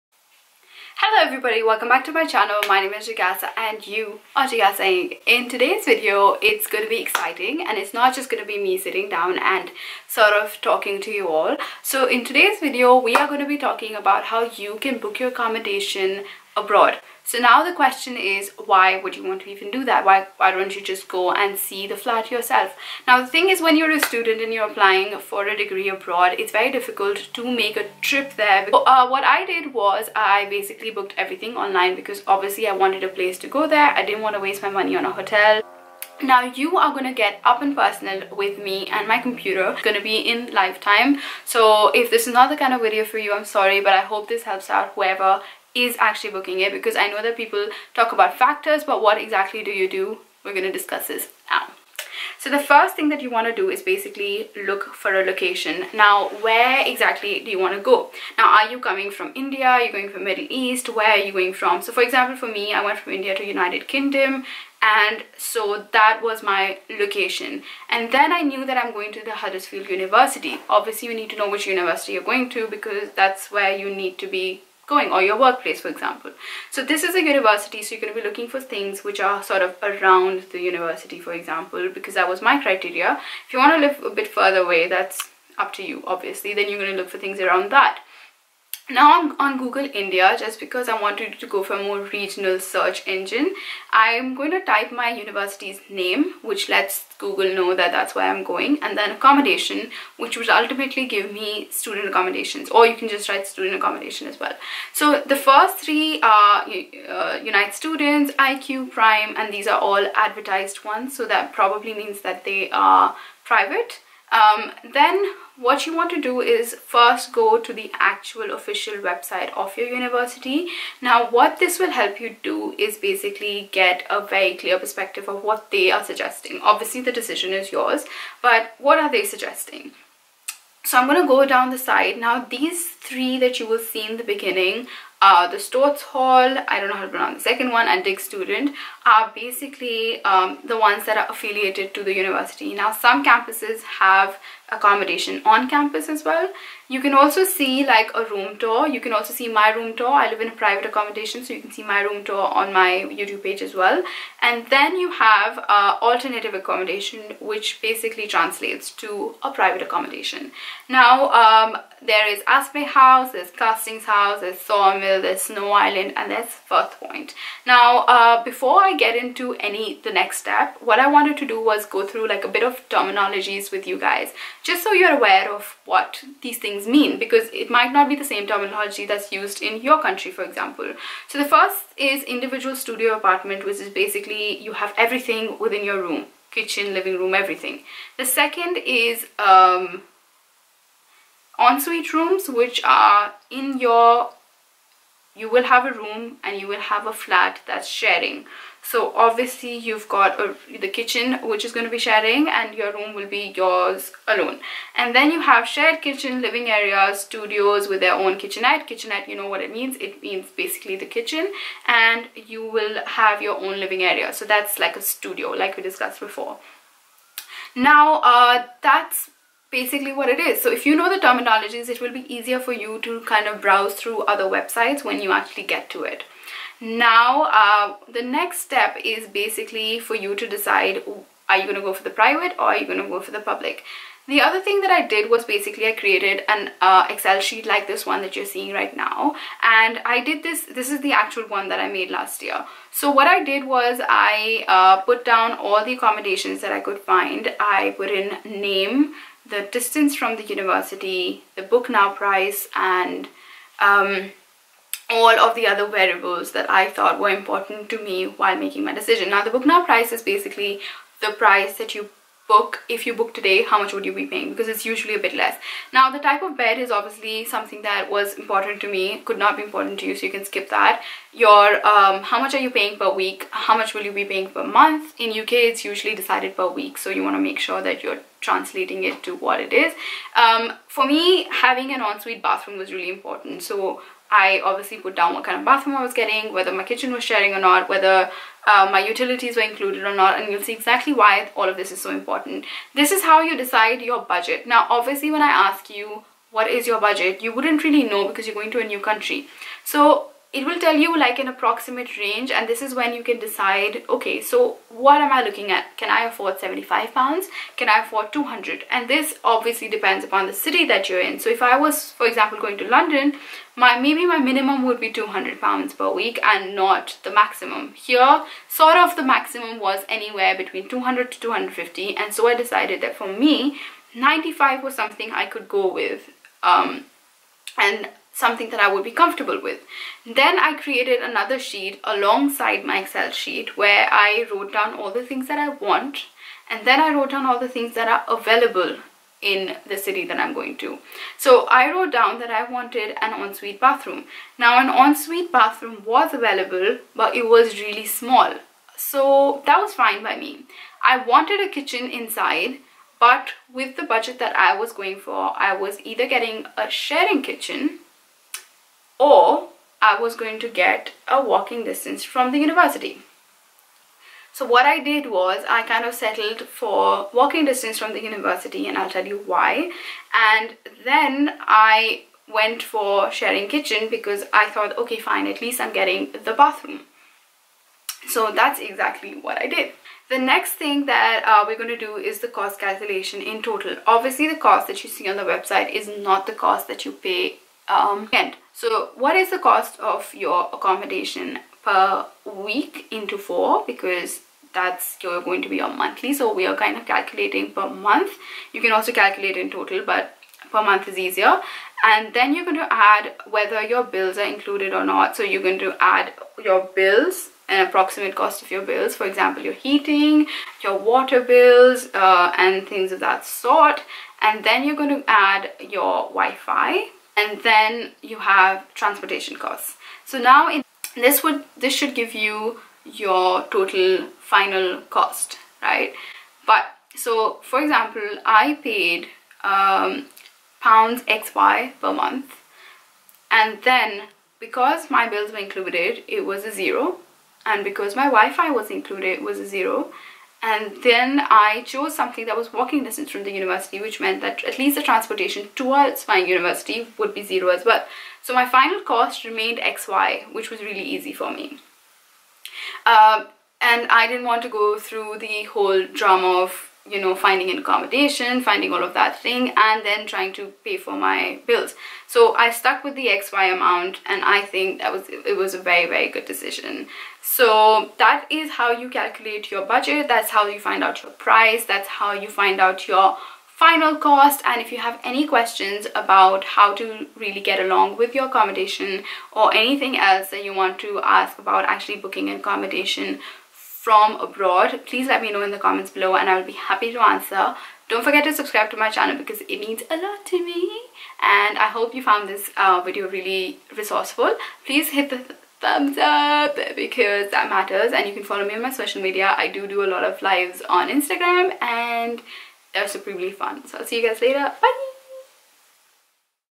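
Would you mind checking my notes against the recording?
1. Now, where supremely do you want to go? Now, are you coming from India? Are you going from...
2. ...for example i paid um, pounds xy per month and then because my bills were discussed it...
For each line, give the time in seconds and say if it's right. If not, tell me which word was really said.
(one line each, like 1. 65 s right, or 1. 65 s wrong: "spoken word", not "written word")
1. 55 s wrong: "exactly", not "supremely"
2. 427 s wrong: "included", not "discussed".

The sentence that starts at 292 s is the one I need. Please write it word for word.
This is how you decide your budget.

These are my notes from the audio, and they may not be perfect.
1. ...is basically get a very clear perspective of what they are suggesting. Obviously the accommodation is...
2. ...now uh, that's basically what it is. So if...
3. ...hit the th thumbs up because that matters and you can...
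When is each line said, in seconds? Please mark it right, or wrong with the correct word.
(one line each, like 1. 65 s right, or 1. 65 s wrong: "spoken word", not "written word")
1. 122 s wrong: "decision", not "accommodation"
2. 217 s right
3. 495 s right.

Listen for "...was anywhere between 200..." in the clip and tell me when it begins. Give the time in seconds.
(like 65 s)
319 s.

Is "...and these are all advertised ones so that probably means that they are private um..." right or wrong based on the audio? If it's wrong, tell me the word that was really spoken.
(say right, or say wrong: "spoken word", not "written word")
right.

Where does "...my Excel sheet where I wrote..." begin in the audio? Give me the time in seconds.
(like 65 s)
332 s.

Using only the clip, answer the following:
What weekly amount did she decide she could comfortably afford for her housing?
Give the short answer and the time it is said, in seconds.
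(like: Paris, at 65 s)
95, at 324 s.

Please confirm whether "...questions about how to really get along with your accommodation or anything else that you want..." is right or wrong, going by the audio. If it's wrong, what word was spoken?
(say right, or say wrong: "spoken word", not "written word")
right.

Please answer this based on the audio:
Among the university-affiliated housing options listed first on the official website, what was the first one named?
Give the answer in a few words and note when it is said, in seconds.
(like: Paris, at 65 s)
Storthes Hall, at 135 s.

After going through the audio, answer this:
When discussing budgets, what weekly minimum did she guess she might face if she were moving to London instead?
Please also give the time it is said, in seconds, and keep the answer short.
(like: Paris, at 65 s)
200 pounds, at 315 s.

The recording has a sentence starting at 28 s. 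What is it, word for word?
uh, what I did was I basically booked everything online because obviously I wanted a place to go there.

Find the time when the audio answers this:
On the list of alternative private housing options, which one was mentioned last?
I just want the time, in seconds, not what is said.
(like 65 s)
166 s.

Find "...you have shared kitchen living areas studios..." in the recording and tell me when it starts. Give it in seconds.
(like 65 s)
205 s.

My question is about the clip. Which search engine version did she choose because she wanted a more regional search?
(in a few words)
Google India.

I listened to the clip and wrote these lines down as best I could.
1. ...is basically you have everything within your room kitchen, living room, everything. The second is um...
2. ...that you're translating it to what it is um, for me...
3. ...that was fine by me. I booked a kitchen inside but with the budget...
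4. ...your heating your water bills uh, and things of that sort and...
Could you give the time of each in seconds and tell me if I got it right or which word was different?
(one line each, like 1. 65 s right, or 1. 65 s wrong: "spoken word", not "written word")
1. 183 s right
2. 277 s right
3. 349 s wrong: "wanted", not "booked"
4. 409 s right.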